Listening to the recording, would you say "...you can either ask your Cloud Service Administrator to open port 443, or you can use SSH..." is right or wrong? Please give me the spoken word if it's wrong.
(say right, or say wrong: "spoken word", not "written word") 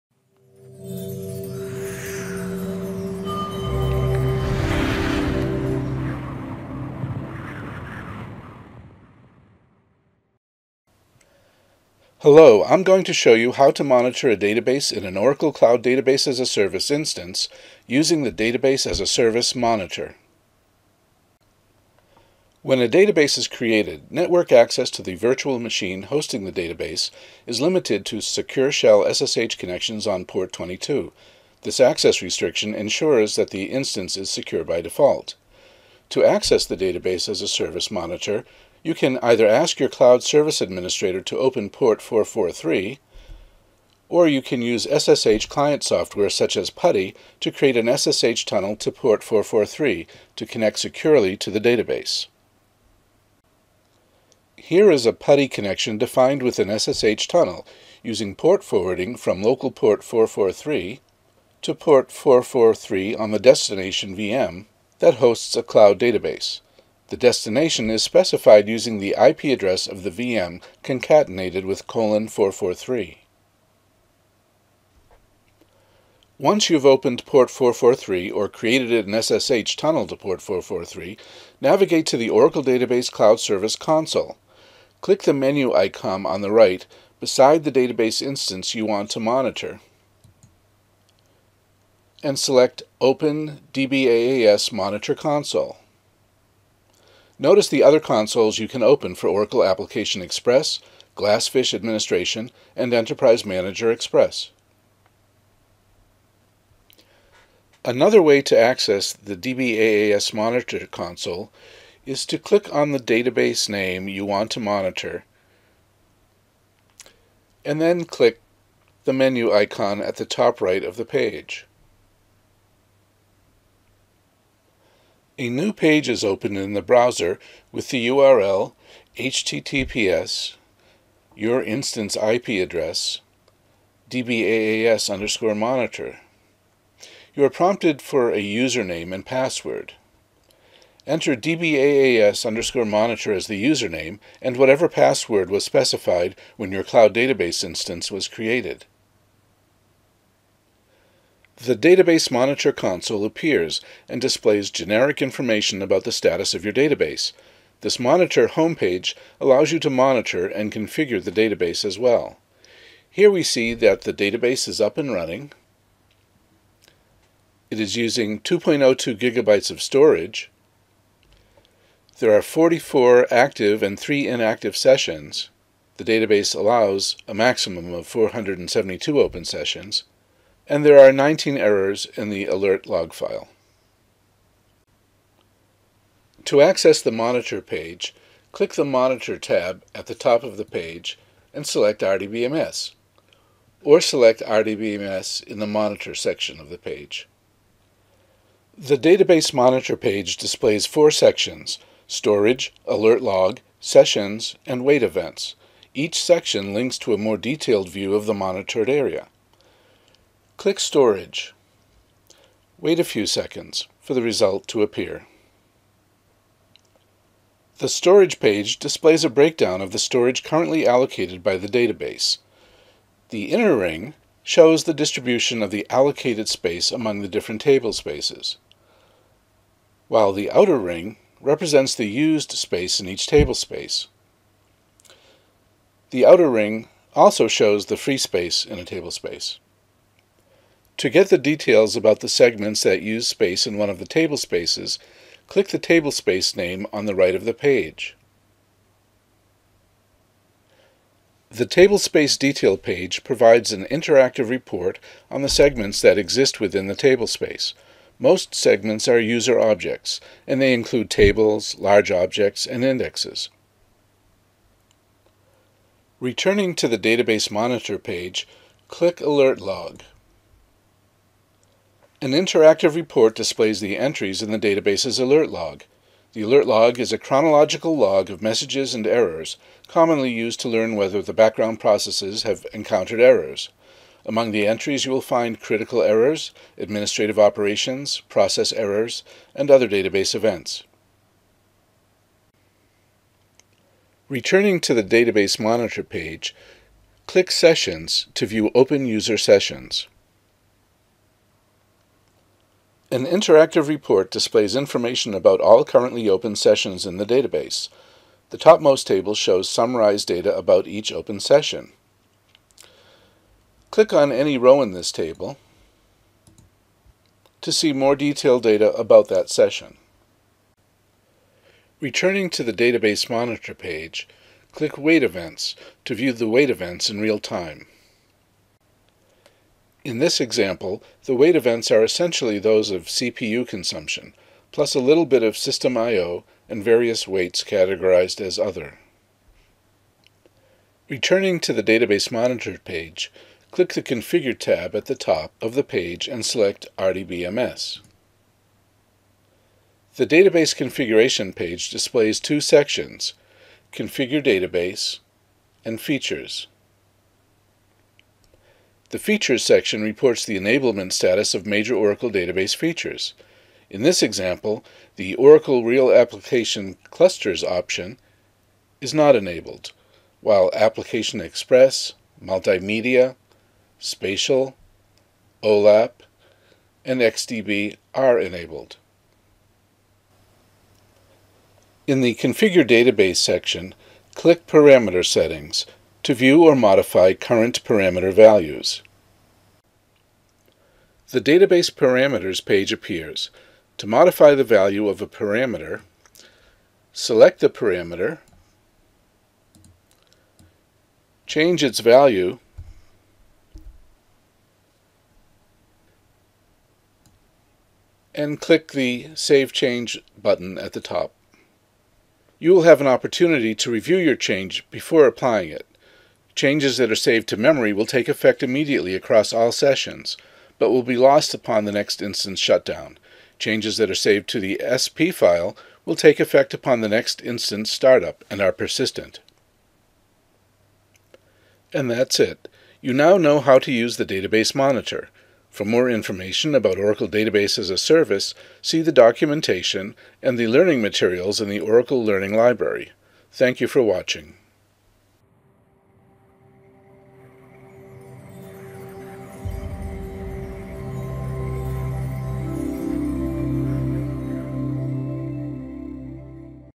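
right.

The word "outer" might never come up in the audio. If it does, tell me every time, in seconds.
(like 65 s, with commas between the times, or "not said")
230 s, 236 s.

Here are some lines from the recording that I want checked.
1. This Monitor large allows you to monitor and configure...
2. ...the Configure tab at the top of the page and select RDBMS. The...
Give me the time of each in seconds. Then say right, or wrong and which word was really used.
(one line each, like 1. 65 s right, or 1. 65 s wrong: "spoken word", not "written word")
1. 157 s wrong: "homepage", not "large"
2. 343 s right.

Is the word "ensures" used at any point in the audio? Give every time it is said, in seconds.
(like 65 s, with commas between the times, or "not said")
32 s.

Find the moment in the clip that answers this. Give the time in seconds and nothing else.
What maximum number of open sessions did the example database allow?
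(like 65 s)
178 s.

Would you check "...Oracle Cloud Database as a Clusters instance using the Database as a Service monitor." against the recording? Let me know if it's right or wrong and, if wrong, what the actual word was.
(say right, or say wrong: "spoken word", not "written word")
wrong: "Service", not "Clusters".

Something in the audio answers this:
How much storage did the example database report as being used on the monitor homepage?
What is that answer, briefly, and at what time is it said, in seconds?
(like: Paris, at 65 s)
2.02 gigabytes, at 168 s.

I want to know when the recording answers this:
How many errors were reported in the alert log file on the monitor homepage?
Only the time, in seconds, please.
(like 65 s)
181 s.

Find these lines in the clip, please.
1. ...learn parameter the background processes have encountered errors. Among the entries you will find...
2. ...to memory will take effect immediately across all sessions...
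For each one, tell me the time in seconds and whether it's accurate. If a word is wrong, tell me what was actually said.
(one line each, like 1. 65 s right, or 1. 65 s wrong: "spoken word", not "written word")
1. 280 s wrong: "whether", not "parameter"
2. 417 s right.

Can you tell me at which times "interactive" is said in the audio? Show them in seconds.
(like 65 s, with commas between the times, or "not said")
253 s, 272 s, 303 s.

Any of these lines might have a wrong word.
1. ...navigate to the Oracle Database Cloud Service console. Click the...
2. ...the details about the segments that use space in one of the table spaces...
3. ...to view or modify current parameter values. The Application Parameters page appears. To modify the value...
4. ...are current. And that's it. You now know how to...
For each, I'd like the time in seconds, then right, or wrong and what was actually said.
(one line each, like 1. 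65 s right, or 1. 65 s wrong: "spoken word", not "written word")
1. 81 s right
2. 241 s right
3. 386 s wrong: "Database", not "Application"
4. 428 s wrong: "persistent", not "current".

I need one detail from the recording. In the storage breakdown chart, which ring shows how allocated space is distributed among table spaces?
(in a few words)
inner ring.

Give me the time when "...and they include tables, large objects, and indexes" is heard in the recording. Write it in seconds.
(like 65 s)
260 s.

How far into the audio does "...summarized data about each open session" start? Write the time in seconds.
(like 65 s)
309 s.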